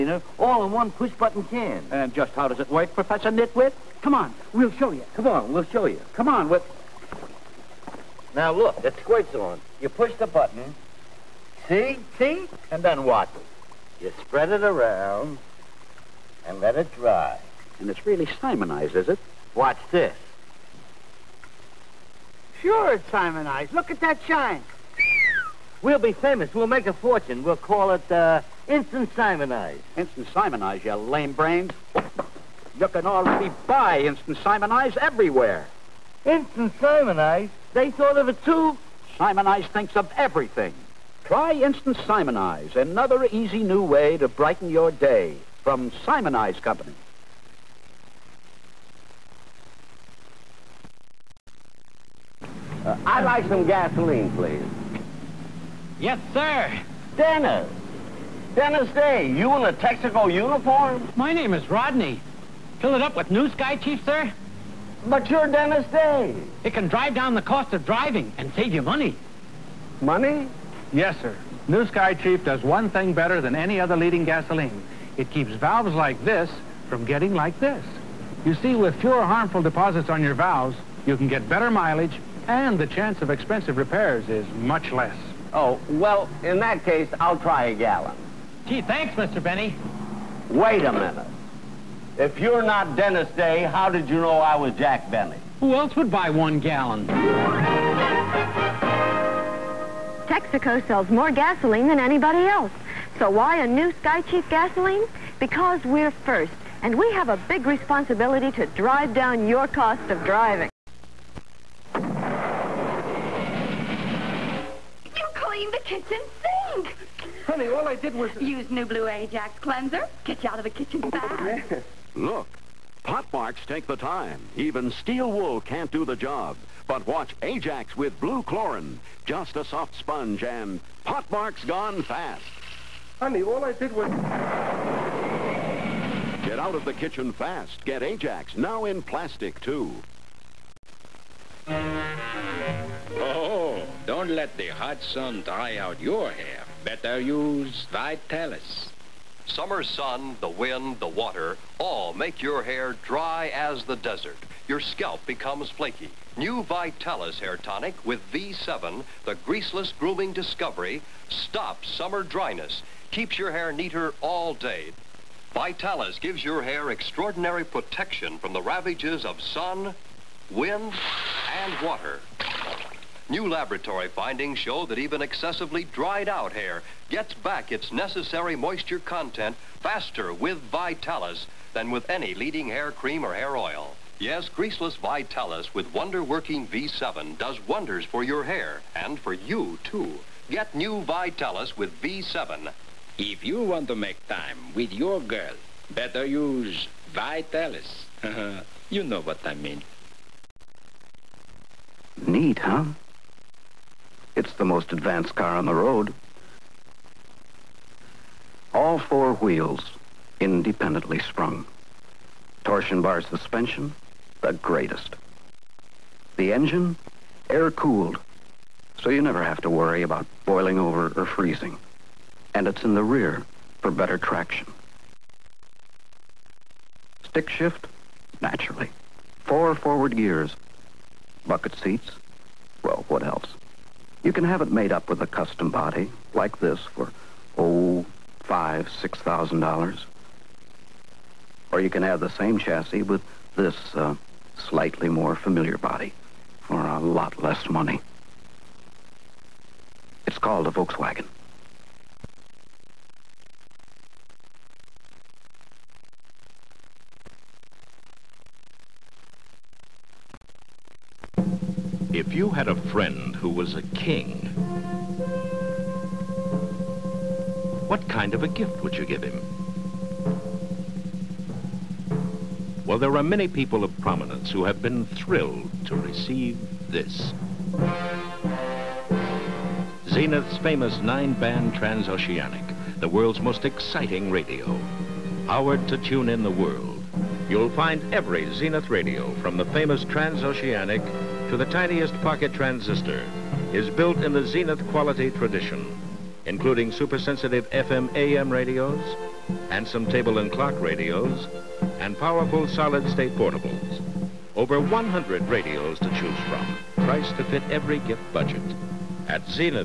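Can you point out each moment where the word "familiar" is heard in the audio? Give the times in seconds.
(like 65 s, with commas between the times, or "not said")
245 s.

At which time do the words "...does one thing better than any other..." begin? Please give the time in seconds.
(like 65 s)
72 s.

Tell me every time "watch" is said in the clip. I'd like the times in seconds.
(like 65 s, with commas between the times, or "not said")
19 s, 127 s.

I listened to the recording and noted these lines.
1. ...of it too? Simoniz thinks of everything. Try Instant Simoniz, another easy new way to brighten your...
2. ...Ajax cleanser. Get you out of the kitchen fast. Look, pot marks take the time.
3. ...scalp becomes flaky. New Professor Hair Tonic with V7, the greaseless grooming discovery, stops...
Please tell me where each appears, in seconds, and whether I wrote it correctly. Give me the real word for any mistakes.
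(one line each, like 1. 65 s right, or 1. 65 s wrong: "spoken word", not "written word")
1. 38 s right
2. 119 s right
3. 154 s wrong: "Vitalis", not "Professor".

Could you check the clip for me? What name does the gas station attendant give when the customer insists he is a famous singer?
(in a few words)
Rodney.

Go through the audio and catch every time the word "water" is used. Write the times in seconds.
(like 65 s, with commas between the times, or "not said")
151 s, 171 s.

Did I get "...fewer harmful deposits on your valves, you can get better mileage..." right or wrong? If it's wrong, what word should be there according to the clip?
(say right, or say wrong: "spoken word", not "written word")
right.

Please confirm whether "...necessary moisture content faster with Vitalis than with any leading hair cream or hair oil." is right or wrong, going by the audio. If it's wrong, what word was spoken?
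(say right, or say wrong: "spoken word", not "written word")
right.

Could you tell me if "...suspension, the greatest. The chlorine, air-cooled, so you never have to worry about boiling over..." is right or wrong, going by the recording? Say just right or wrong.
wrong.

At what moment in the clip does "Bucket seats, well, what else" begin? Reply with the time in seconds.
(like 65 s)
231 s.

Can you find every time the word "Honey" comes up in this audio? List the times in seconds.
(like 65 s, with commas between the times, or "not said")
117 s, 133 s.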